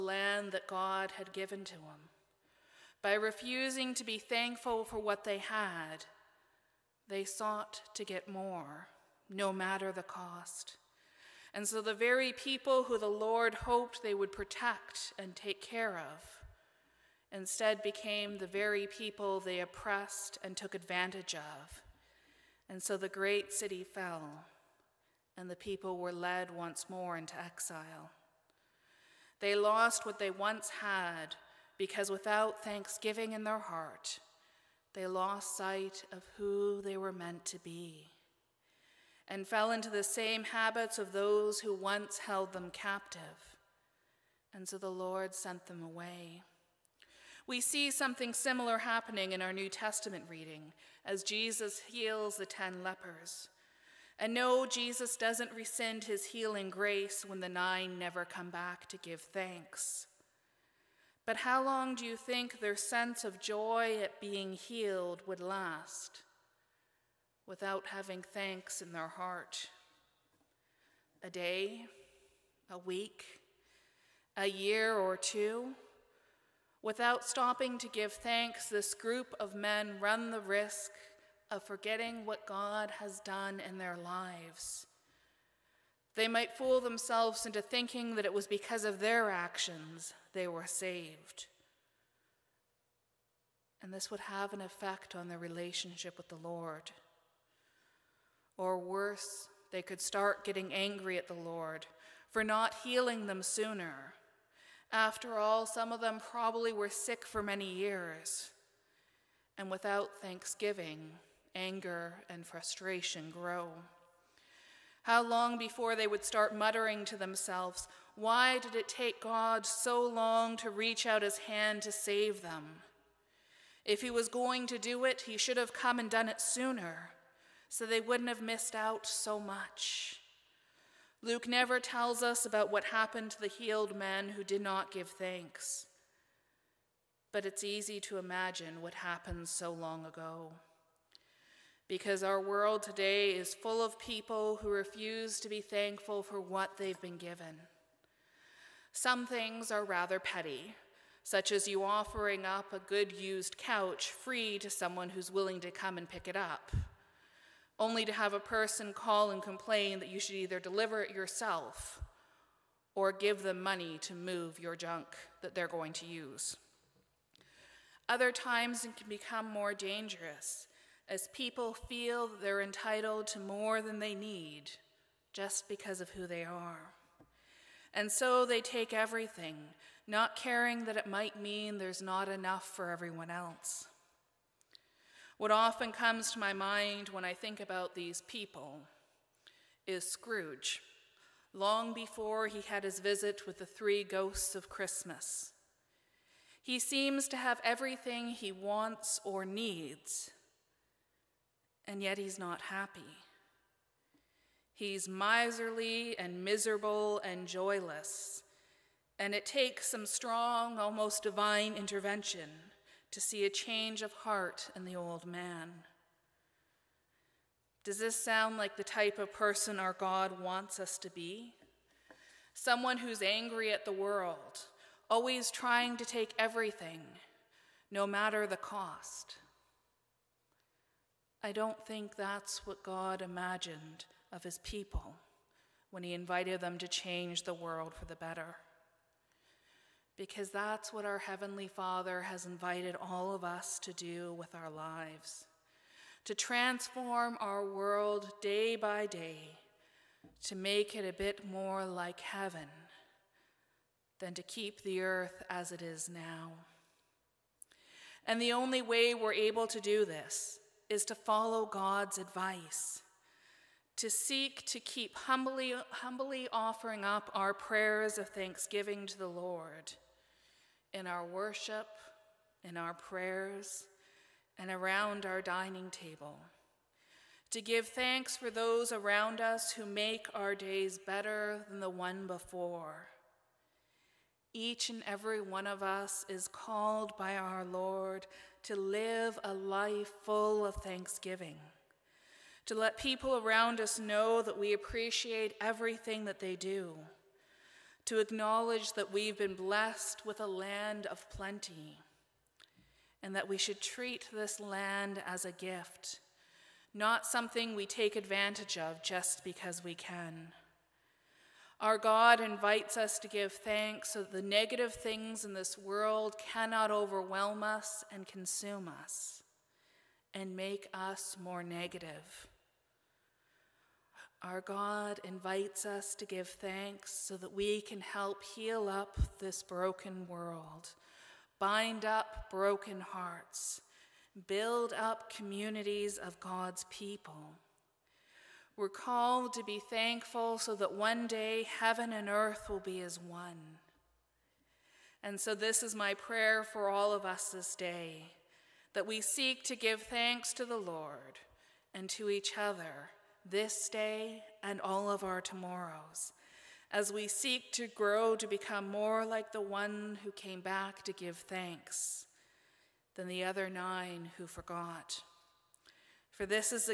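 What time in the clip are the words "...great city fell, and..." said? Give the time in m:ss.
0:23.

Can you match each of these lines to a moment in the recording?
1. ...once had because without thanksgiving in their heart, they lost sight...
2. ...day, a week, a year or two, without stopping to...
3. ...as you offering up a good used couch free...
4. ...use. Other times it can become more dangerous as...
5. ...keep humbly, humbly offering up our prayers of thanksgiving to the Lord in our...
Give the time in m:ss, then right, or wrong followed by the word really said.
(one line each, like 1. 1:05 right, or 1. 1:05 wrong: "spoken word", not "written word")
1. 0:30 right
2. 1:11 right
3. 2:31 right
4. 2:46 right
5. 4:24 right.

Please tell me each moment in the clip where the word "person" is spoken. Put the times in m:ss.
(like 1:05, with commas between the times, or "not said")
2:38, 3:39.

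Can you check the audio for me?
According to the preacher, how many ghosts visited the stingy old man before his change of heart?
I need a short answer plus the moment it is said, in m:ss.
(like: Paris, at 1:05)
3, at 3:13.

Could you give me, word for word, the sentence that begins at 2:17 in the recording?
But it's easy to imagine what happened so long ago.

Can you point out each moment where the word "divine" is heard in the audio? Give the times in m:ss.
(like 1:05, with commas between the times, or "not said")
3:31.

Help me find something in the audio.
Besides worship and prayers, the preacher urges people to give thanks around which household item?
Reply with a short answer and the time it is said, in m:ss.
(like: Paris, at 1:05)
Dining table, at 4:35.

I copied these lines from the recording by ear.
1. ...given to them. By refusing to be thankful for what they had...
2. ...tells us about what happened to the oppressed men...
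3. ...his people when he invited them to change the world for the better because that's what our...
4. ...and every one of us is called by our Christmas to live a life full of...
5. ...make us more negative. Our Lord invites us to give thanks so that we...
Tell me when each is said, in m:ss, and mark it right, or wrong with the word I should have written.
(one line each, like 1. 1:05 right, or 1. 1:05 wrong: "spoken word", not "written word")
1. 0:01 right
2. 2:11 wrong: "healed", not "oppressed"
3. 3:54 right
4. 4:44 wrong: "Lord", not "Christmas"
5. 5:20 wrong: "God", not "Lord".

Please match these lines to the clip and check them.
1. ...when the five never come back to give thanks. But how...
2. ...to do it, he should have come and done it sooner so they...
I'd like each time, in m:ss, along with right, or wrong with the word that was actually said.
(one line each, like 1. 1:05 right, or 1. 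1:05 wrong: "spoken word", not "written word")
1. 0:57 wrong: "nine", not "five"
2. 2:04 right.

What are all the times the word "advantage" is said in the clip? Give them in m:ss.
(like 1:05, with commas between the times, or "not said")
0:20, 5:08.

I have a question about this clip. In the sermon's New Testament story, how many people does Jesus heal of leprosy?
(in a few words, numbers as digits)
10.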